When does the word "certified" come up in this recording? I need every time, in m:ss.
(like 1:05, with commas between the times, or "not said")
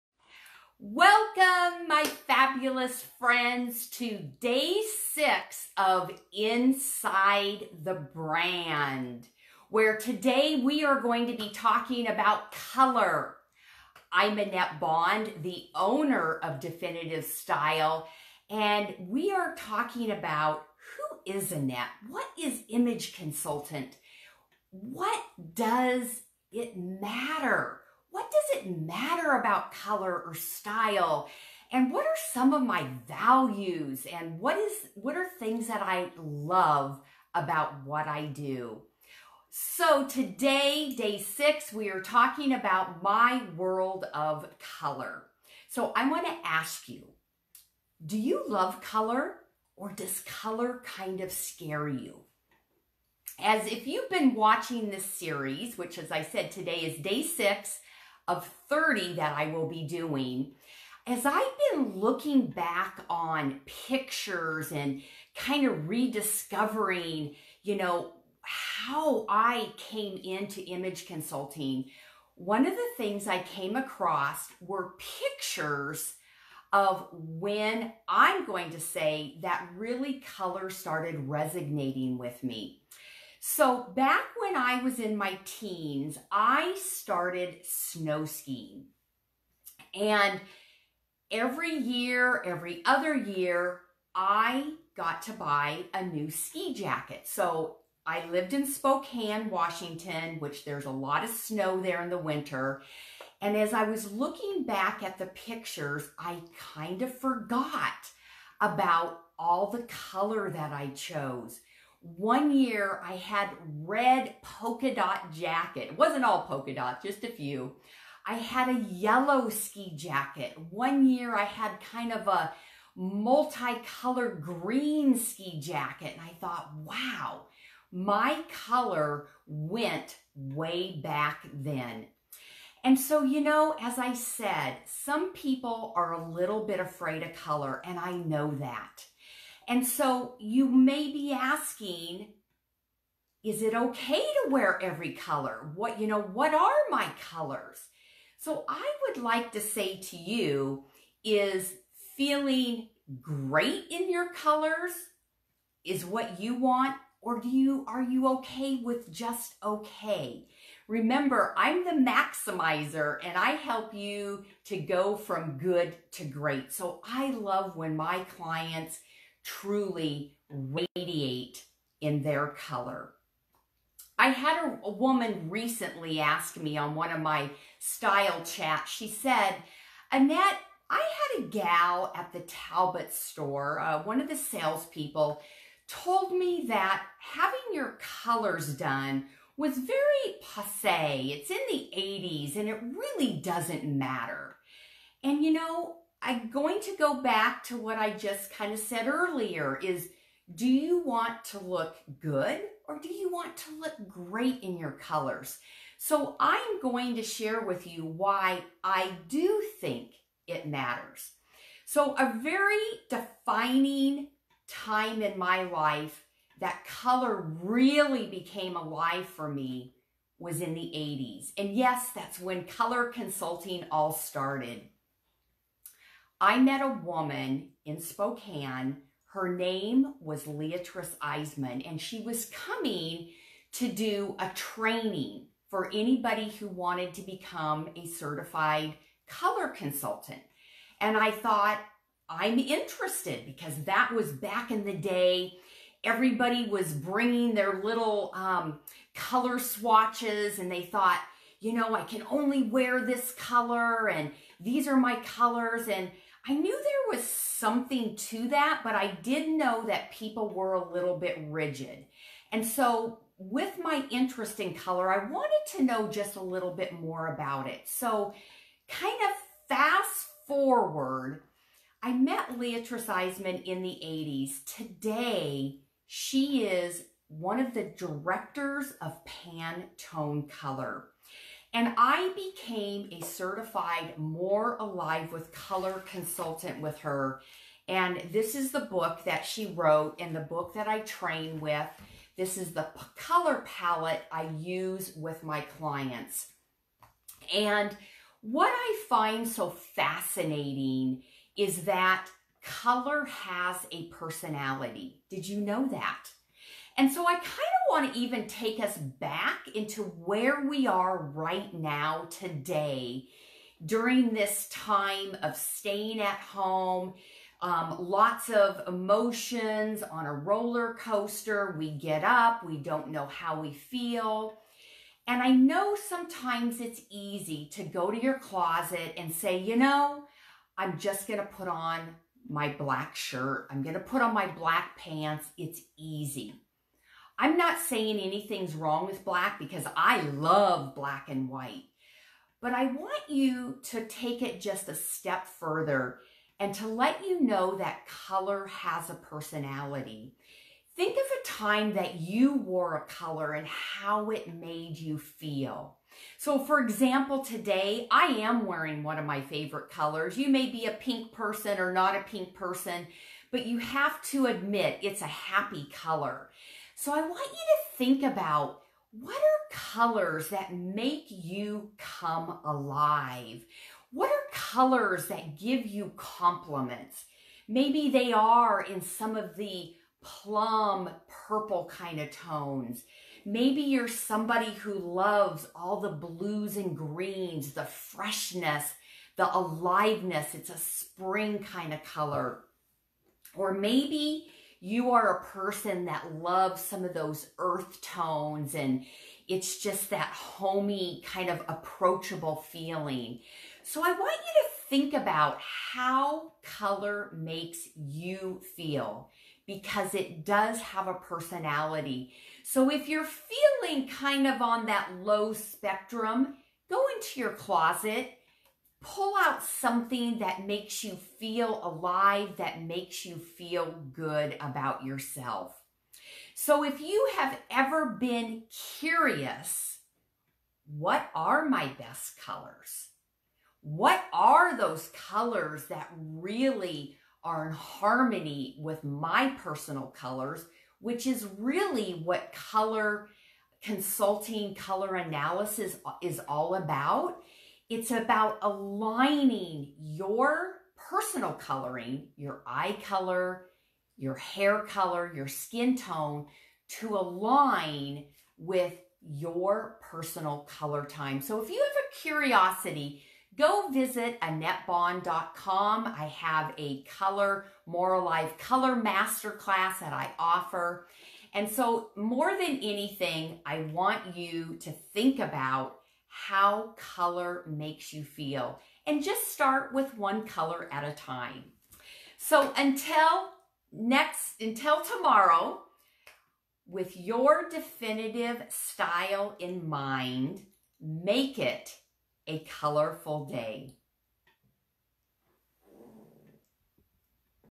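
3:58, 4:43.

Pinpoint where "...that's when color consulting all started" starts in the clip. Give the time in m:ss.
3:42.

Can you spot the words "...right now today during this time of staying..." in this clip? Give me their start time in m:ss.
5:11.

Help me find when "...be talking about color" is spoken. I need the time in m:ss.
0:11.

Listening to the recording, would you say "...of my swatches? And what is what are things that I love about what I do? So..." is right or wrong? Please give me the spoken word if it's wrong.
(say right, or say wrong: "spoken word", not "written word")
wrong: "values", not "swatches".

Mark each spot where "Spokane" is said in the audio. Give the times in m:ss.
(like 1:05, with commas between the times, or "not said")
1:38, 3:48.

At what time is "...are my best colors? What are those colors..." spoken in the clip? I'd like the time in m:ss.
7:11.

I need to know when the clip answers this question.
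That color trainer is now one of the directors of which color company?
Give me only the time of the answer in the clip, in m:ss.
4:39.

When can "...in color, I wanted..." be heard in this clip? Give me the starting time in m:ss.
4:24.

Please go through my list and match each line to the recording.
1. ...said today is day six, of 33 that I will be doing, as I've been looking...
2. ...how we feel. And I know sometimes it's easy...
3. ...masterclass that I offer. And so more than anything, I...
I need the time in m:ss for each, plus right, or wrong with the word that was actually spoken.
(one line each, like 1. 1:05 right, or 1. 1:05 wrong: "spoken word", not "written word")
1. 0:56 wrong: "30", not "33"
2. 5:23 right
3. 7:48 right.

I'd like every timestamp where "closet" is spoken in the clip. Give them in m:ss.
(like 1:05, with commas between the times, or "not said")
5:28, 6:57.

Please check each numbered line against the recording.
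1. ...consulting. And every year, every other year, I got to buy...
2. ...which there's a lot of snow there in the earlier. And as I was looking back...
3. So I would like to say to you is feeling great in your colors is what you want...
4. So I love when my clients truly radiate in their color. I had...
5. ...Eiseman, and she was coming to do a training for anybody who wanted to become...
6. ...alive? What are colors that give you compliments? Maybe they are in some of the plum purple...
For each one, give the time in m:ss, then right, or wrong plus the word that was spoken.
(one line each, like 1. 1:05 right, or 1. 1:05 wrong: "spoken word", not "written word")
1. 1:28 wrong: "skiing", not "consulting"
2. 1:40 wrong: "winter", not "earlier"
3. 2:28 right
4. 2:46 right
5. 3:51 right
6. 6:12 right.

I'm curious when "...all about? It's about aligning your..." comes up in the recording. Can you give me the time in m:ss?
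7:26.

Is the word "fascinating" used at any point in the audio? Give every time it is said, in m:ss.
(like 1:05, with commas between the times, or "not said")
4:59.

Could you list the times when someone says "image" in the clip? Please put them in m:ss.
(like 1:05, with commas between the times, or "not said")
0:22, 1:10.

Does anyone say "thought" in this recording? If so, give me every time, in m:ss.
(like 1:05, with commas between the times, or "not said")
2:06, 4:01, 4:10.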